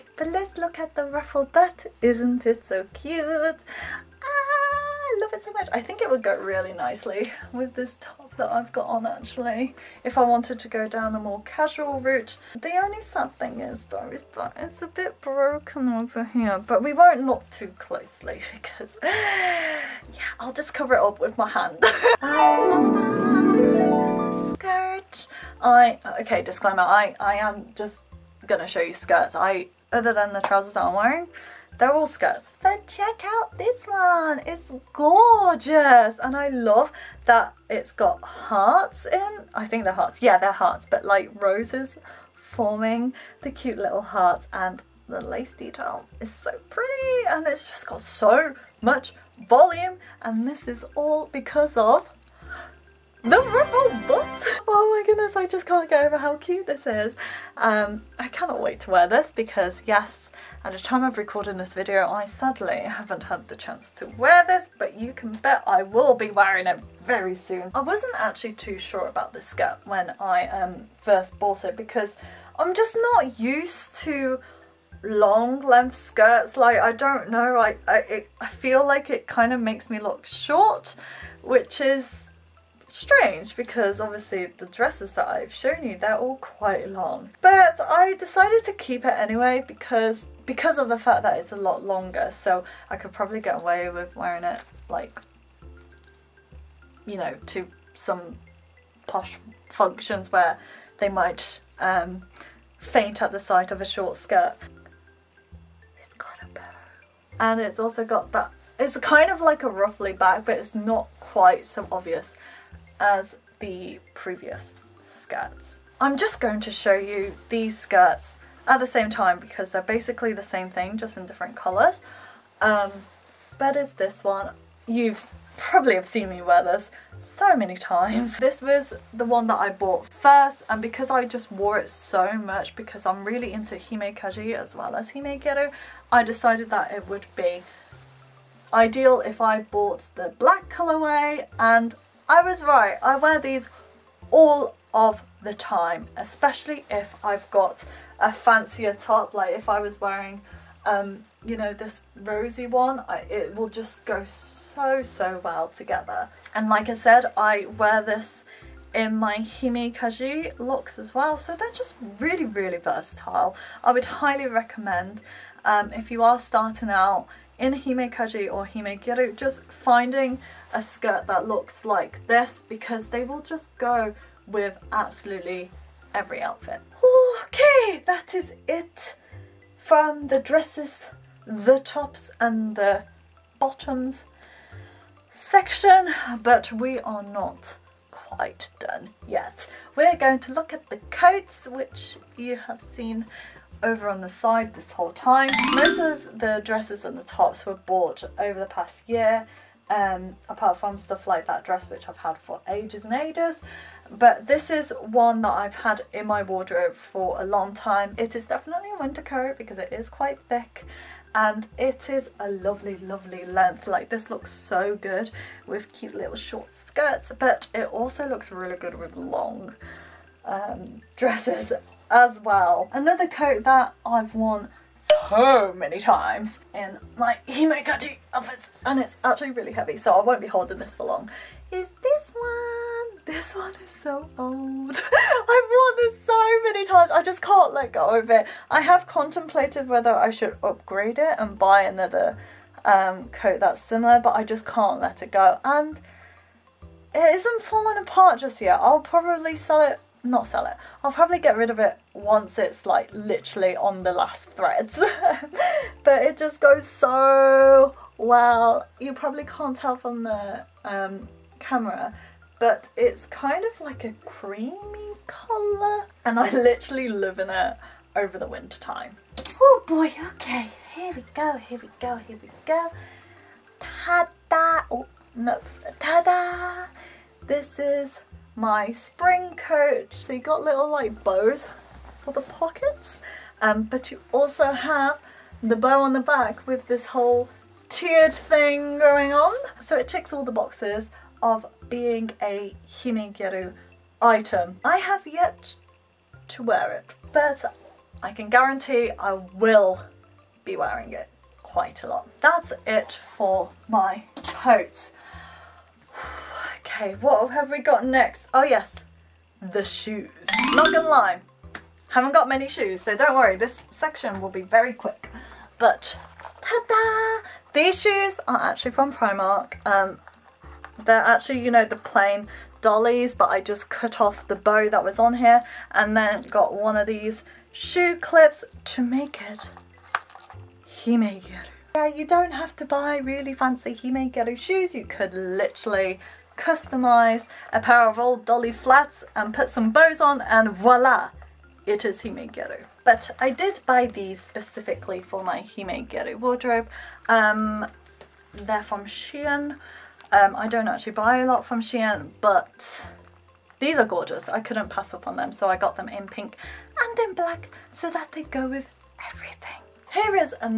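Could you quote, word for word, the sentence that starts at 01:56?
I'm just going to show you these skirts at the same time because they're basically the same thing just in different colours.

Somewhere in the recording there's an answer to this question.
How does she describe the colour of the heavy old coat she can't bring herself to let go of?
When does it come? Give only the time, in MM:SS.
04:24.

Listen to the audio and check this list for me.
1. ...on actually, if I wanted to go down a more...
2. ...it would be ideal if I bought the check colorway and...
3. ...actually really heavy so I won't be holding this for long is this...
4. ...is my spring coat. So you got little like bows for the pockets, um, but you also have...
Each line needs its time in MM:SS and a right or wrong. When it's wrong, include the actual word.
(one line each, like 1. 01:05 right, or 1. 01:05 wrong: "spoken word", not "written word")
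1. 00:08 right
2. 02:16 wrong: "black", not "check"
3. 03:49 right
4. 04:37 right.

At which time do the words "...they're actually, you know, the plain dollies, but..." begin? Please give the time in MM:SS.
05:21.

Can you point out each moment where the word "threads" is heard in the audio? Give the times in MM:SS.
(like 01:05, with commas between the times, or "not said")
04:14.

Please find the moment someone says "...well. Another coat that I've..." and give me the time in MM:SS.
03:42.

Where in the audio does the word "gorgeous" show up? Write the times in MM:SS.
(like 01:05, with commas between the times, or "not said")
00:34, 05:54.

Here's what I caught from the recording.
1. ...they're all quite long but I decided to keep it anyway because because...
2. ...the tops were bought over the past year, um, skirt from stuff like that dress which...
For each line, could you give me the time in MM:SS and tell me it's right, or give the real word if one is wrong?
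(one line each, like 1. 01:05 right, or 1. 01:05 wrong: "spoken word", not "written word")
1. 01:25 right
2. 03:17 wrong: "apart", not "skirt".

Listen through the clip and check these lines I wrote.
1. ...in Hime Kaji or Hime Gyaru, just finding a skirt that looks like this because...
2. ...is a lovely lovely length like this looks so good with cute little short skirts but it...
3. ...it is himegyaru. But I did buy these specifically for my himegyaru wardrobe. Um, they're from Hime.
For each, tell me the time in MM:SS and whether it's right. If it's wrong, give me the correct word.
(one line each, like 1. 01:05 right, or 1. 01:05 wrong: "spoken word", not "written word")
1. 02:47 right
2. 03:32 right
3. 05:41 wrong: "Shein", not "Hime".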